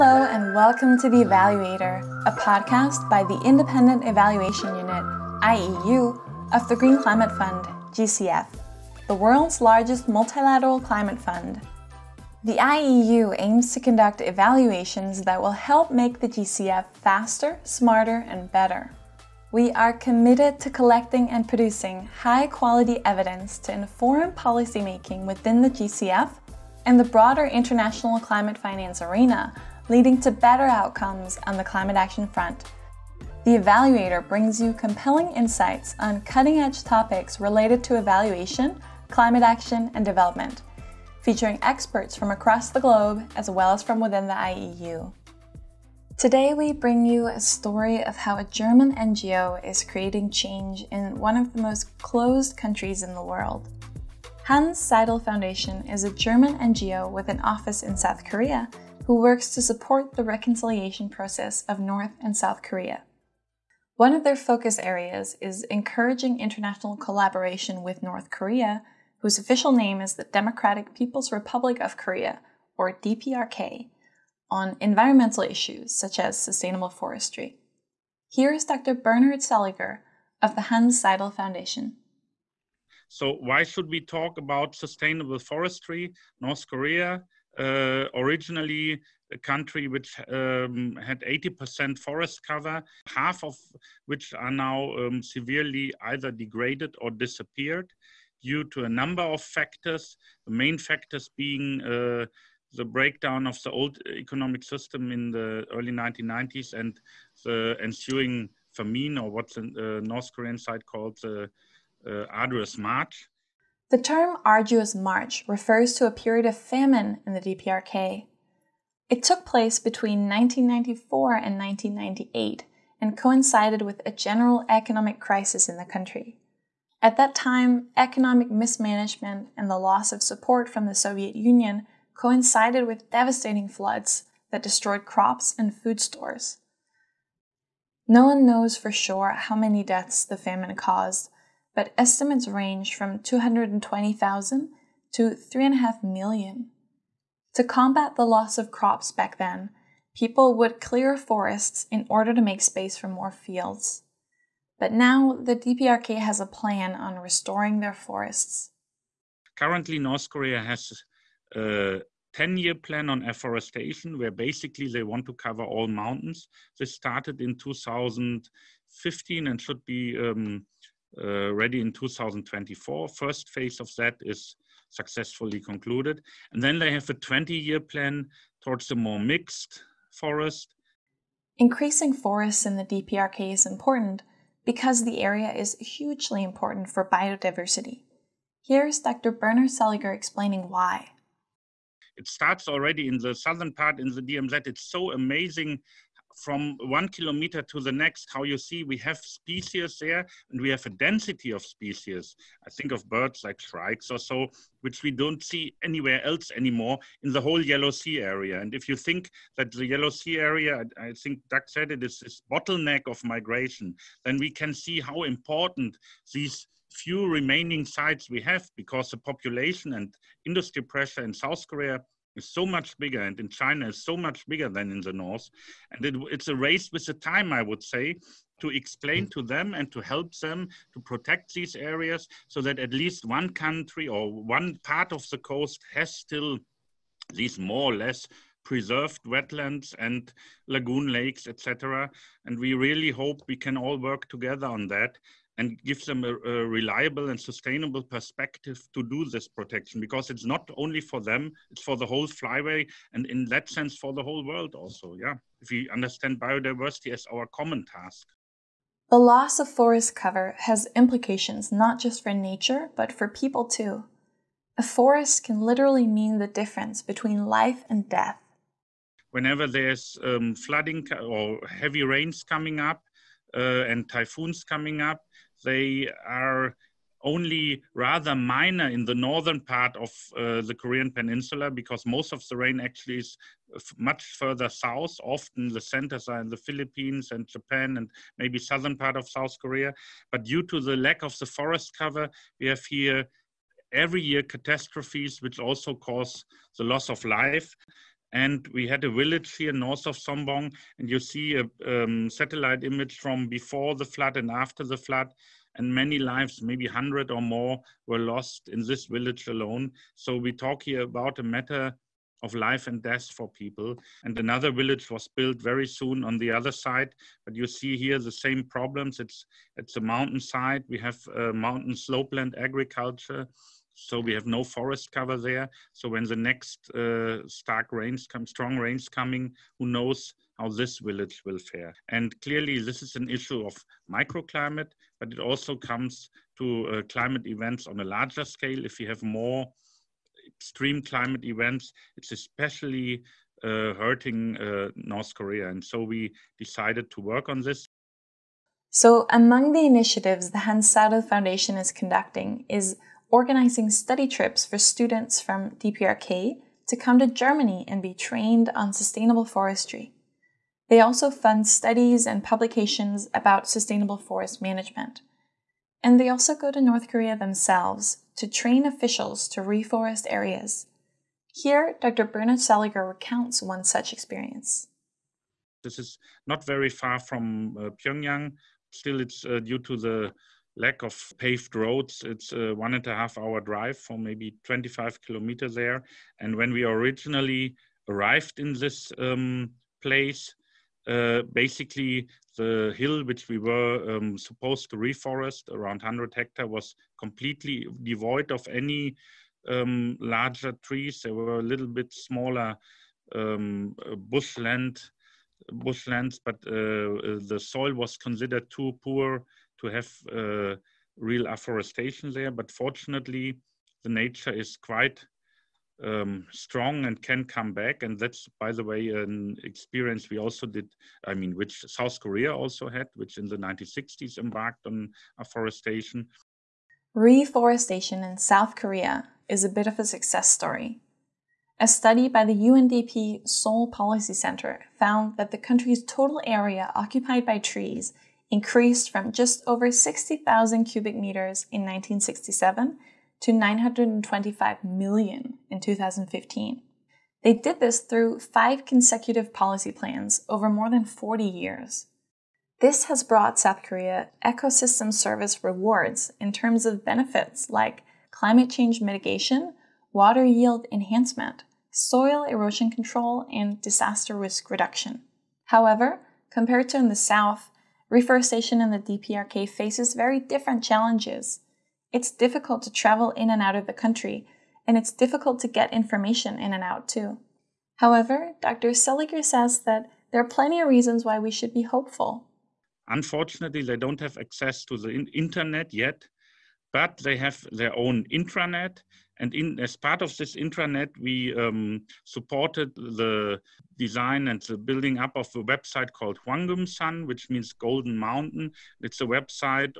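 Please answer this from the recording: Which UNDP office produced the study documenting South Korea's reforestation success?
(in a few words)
Seoul Policy Center.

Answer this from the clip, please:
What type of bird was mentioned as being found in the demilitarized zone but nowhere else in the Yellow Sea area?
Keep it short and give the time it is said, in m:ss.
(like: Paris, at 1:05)
shrikes, at 3:23.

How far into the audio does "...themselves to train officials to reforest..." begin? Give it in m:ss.
6:07.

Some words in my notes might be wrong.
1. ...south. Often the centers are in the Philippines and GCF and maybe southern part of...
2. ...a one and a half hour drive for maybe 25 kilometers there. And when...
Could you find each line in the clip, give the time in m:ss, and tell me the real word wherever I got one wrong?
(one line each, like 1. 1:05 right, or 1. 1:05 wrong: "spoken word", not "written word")
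1. 4:44 wrong: "Japan", not "GCF"
2. 6:22 right.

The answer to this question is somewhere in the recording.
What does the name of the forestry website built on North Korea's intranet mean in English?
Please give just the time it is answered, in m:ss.
8:17.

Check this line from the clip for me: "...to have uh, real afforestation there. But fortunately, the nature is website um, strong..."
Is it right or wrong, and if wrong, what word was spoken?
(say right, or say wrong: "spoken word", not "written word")
wrong: "quite", not "website".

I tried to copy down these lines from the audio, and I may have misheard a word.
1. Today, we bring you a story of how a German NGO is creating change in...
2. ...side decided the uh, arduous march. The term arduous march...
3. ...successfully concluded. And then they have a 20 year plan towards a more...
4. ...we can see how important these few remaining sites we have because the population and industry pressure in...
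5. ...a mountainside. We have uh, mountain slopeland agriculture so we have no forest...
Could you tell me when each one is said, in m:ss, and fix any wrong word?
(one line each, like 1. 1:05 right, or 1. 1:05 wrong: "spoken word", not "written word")
1. 0:46 right
2. 1:50 wrong: "called", not "decided"
3. 2:54 right
4. 3:34 right
5. 5:19 right.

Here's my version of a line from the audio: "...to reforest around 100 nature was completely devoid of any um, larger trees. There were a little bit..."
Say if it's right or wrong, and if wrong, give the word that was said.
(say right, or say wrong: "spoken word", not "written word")
wrong: "hectare", not "nature".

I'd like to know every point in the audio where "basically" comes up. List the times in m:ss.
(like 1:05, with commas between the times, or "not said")
2:44, 6:31.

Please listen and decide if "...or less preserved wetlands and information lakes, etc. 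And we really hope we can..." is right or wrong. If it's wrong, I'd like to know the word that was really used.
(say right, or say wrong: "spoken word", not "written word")
wrong: "lagoon", not "information".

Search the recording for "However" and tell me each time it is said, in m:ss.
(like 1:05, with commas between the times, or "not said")
7:45, 7:57.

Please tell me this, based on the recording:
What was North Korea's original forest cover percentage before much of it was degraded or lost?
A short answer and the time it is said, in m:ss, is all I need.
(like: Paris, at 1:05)
80%, at 1:31.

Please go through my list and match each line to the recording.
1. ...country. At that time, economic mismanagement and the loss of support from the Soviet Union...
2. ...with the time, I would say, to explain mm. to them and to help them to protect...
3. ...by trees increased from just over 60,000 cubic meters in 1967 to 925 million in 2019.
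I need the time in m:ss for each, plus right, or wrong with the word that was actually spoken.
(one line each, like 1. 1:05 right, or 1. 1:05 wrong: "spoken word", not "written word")
1. 2:05 right
2. 3:46 right
3. 7:17 wrong: "2015", not "2019".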